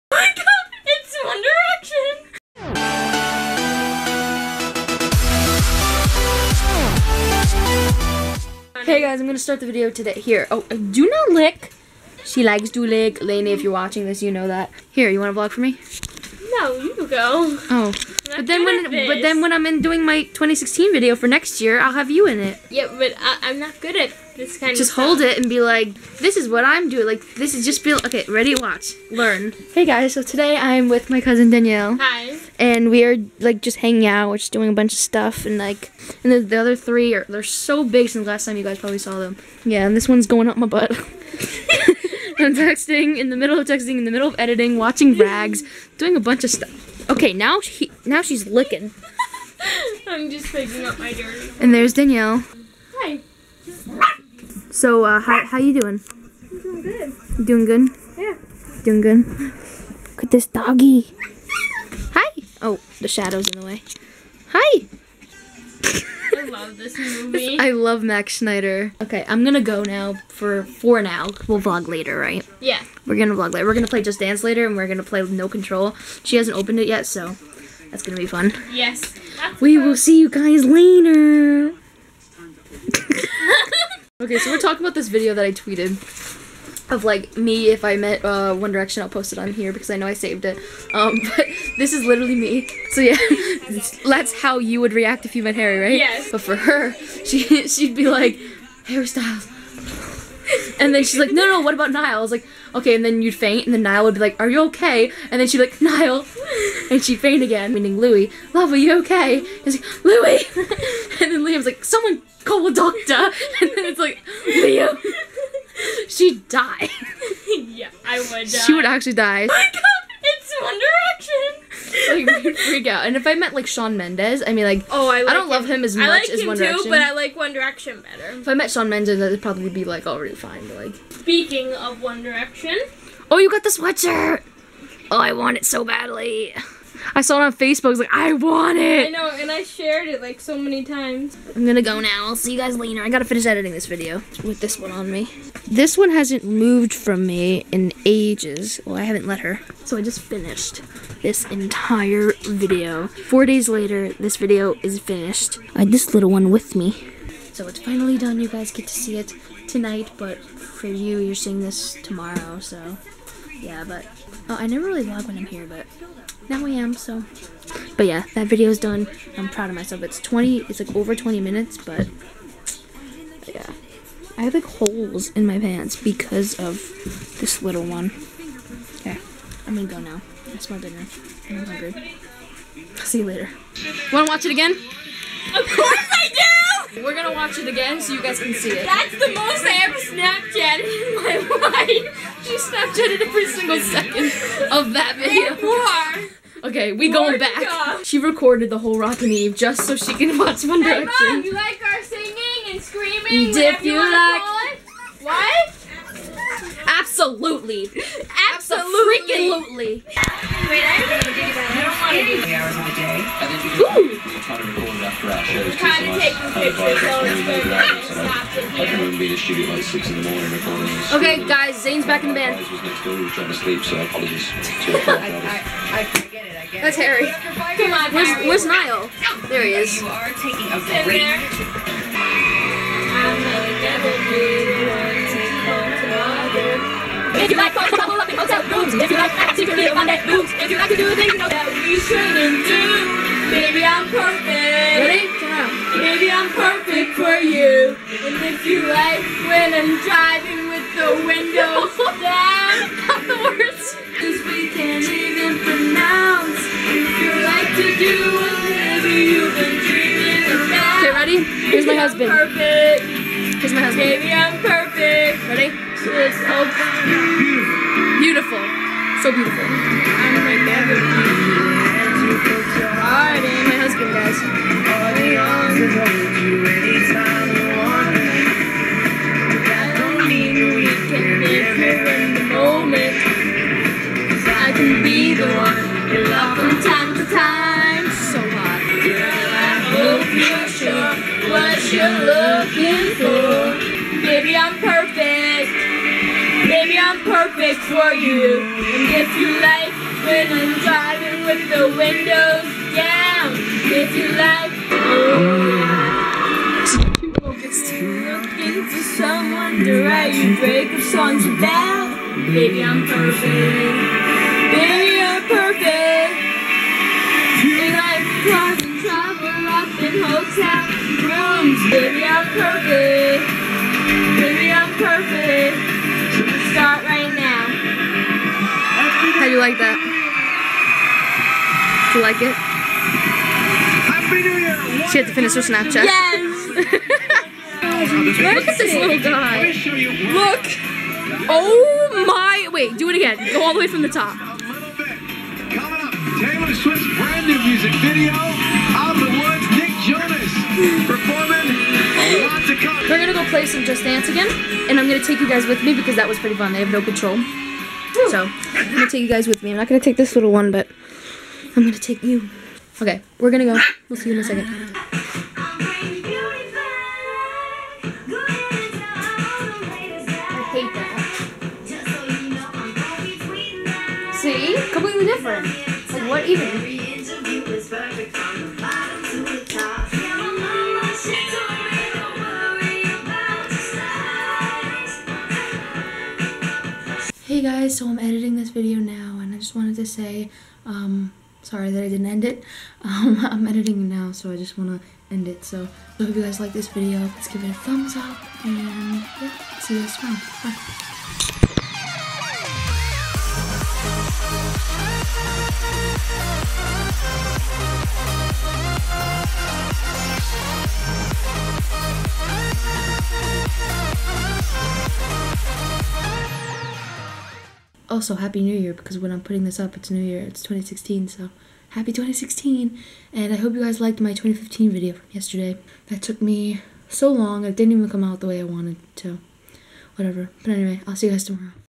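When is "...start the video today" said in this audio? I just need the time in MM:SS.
00:09.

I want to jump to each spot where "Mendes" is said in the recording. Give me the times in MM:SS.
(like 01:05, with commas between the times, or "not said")
02:03, 02:08.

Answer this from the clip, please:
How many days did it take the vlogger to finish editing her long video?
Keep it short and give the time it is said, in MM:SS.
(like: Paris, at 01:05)
4, at 02:33.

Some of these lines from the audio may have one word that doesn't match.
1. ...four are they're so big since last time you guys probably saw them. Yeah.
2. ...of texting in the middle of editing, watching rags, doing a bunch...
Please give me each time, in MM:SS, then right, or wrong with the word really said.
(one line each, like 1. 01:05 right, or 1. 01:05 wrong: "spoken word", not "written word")
1. 00:36 wrong: "three", not "four"
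2. 00:43 right.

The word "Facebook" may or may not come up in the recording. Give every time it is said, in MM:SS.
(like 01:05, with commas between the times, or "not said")
02:17.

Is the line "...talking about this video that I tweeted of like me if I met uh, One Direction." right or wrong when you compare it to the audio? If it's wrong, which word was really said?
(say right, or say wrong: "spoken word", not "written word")
right.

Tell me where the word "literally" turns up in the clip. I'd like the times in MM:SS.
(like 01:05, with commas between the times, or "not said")
01:32.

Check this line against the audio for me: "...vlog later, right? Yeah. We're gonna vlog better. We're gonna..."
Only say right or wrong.
wrong.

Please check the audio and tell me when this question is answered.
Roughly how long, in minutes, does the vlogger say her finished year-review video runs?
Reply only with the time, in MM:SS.
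02:50.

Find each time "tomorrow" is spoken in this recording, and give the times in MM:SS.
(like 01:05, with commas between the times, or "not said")
02:42, 06:40, 07:11.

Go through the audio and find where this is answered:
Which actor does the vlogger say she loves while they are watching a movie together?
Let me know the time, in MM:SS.
01:08.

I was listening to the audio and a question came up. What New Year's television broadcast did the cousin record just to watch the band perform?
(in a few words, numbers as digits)
Rockin' Eve.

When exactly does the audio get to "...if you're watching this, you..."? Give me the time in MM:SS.
00:13.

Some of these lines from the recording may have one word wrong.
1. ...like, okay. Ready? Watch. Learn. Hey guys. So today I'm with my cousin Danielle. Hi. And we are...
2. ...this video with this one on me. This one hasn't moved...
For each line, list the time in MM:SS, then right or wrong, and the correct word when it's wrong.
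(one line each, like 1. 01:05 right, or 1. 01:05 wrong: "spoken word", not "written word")
1. 00:27 right
2. 02:23 right.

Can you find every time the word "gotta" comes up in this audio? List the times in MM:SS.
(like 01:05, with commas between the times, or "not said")
02:23.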